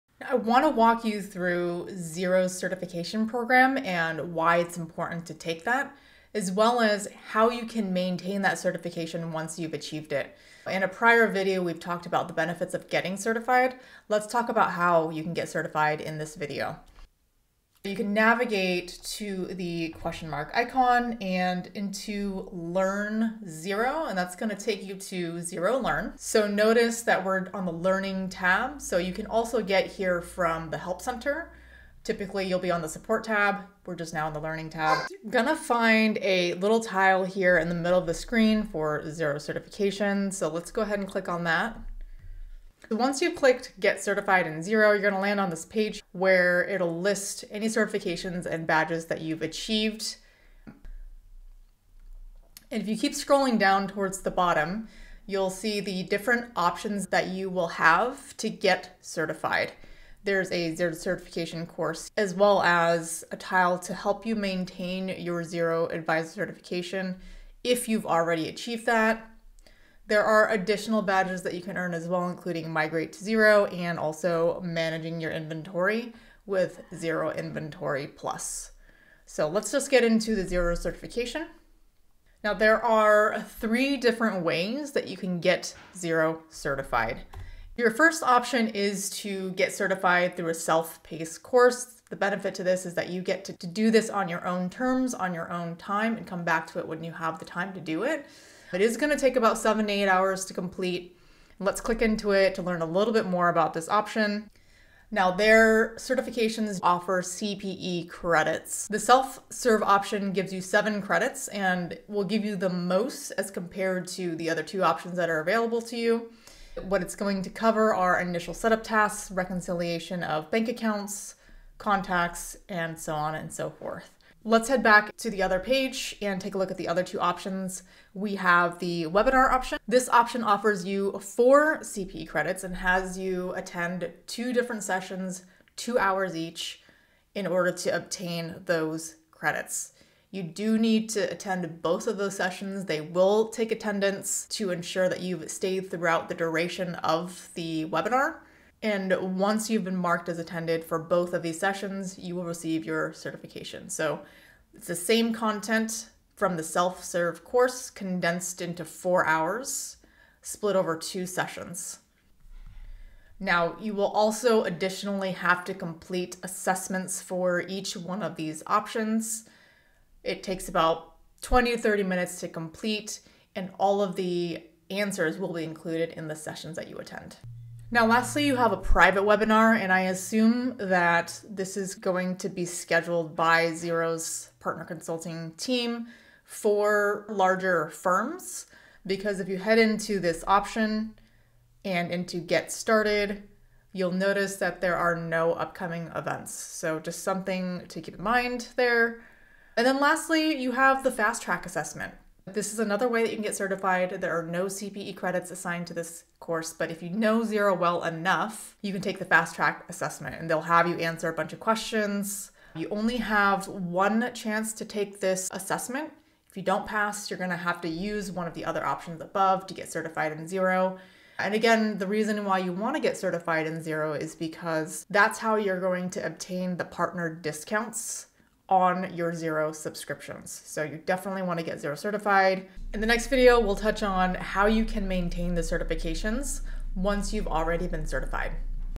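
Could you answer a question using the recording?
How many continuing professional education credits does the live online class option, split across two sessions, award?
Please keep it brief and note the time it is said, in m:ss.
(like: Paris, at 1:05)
4, at 2:11.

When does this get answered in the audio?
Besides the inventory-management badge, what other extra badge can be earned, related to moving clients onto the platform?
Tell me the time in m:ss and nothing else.
1:12.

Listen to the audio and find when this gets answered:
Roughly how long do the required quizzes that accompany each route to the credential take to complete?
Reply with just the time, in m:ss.
2:51.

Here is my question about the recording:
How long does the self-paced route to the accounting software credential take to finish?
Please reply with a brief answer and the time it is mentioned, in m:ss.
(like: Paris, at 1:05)
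7 to 8 hours, at 1:39.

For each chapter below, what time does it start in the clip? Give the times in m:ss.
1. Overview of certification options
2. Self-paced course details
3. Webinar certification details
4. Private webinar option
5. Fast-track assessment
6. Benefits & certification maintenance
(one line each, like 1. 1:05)
1. 0:35
2. 0:55
3. 1:35
4. 2:15
5. 2:35
6. 3:00.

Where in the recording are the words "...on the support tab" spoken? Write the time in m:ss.
0:32.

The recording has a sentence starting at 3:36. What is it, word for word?
If you don't pass, you're gonna have to use one of the other options above to get certified in Xero.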